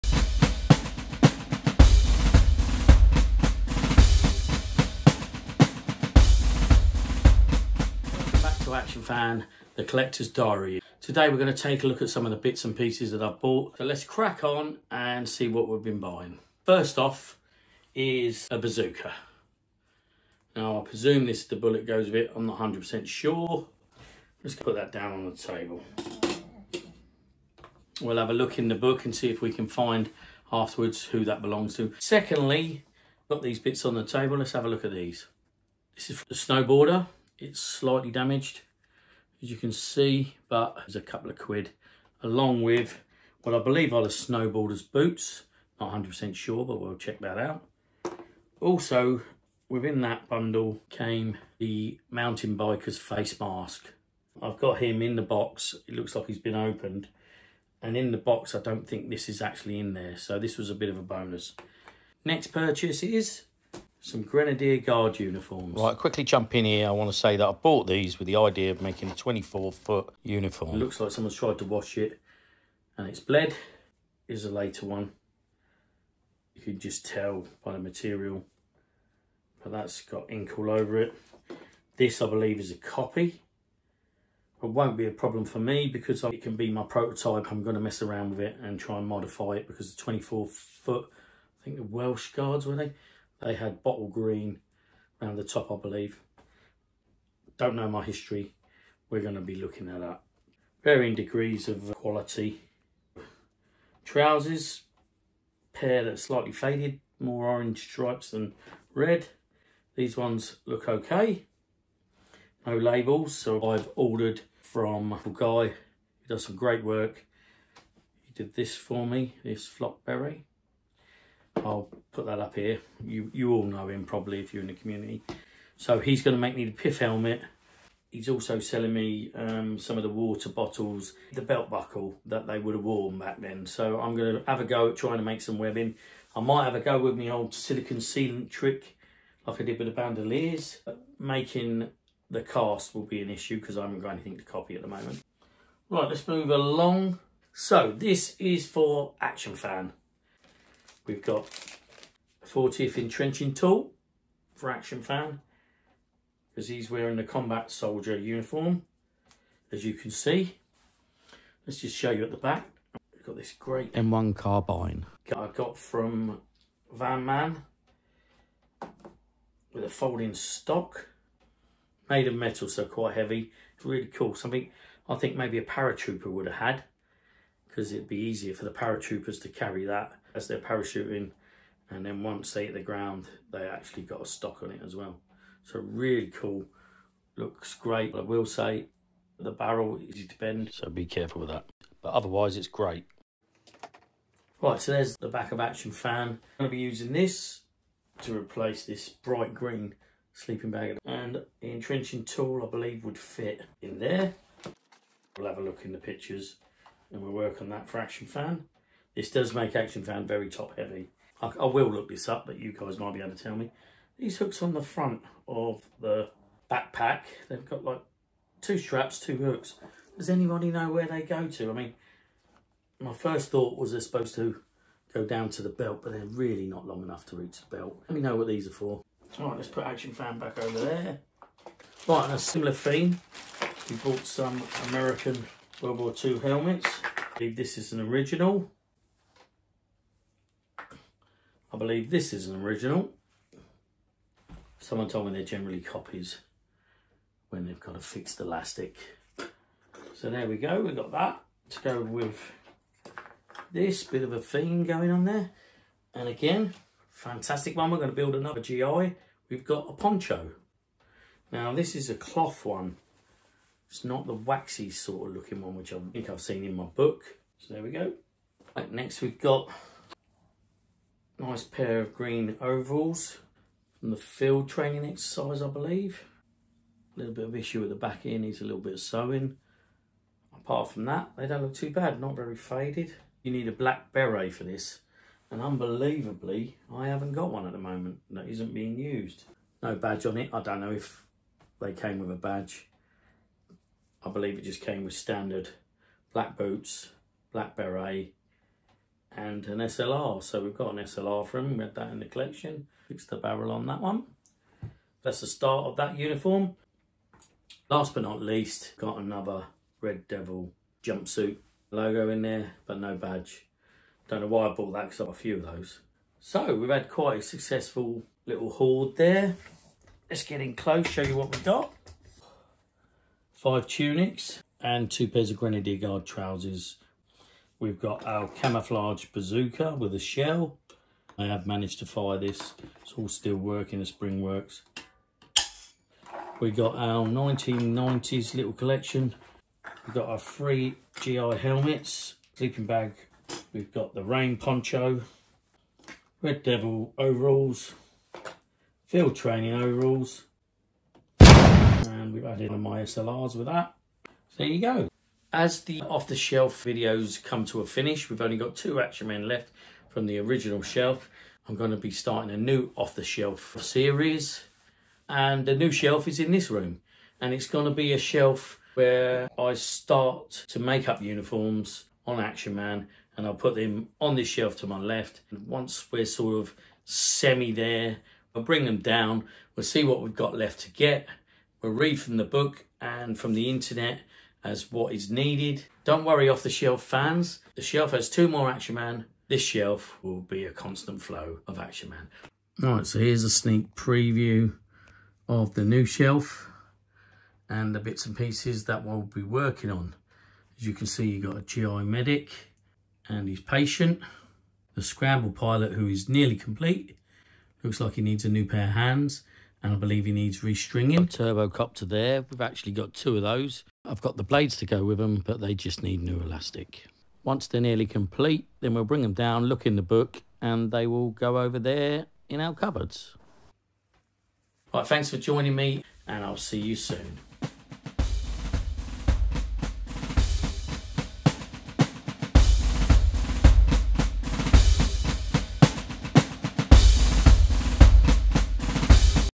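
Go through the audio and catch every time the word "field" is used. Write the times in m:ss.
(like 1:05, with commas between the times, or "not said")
4:34, 5:49.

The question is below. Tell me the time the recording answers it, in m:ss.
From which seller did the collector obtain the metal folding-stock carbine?
2:46.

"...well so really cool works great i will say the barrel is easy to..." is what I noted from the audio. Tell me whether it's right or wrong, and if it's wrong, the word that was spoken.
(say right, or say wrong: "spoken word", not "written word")
wrong: "looks", not "works".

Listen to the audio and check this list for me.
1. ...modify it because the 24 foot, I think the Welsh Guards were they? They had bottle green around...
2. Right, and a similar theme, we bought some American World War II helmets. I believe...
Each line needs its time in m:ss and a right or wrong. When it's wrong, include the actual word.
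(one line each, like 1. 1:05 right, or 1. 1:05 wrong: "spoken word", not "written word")
1. 1:29 right
2. 3:52 right.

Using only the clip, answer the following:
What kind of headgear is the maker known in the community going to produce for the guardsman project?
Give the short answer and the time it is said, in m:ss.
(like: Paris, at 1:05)
Pith helmet, at 2:06.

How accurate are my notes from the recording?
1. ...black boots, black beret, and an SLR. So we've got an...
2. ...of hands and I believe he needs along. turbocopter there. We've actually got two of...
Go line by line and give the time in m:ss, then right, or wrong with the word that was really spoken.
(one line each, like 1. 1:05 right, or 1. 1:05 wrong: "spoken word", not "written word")
1. 4:56 right
2. 6:48 wrong: "restringing", not "along".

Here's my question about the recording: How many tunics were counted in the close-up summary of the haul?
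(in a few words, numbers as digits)
5.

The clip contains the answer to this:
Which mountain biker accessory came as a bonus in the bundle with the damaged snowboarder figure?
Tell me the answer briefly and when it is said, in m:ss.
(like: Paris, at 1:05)
Face mask, at 0:52.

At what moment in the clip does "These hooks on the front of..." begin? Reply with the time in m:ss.
3:34.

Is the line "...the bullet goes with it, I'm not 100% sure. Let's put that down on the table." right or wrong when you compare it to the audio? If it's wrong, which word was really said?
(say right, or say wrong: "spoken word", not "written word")
right.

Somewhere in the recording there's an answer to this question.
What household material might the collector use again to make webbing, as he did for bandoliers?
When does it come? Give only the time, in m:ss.
2:17.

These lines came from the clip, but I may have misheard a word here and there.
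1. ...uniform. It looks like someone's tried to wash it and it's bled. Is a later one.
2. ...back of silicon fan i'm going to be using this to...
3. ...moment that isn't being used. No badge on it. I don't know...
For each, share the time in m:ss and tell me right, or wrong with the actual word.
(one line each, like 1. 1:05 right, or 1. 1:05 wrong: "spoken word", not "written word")
1. 1:10 right
2. 3:15 wrong: "action", not "silicon"
3. 4:47 right.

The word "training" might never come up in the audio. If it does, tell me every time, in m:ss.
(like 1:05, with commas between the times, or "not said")
4:34, 5:49.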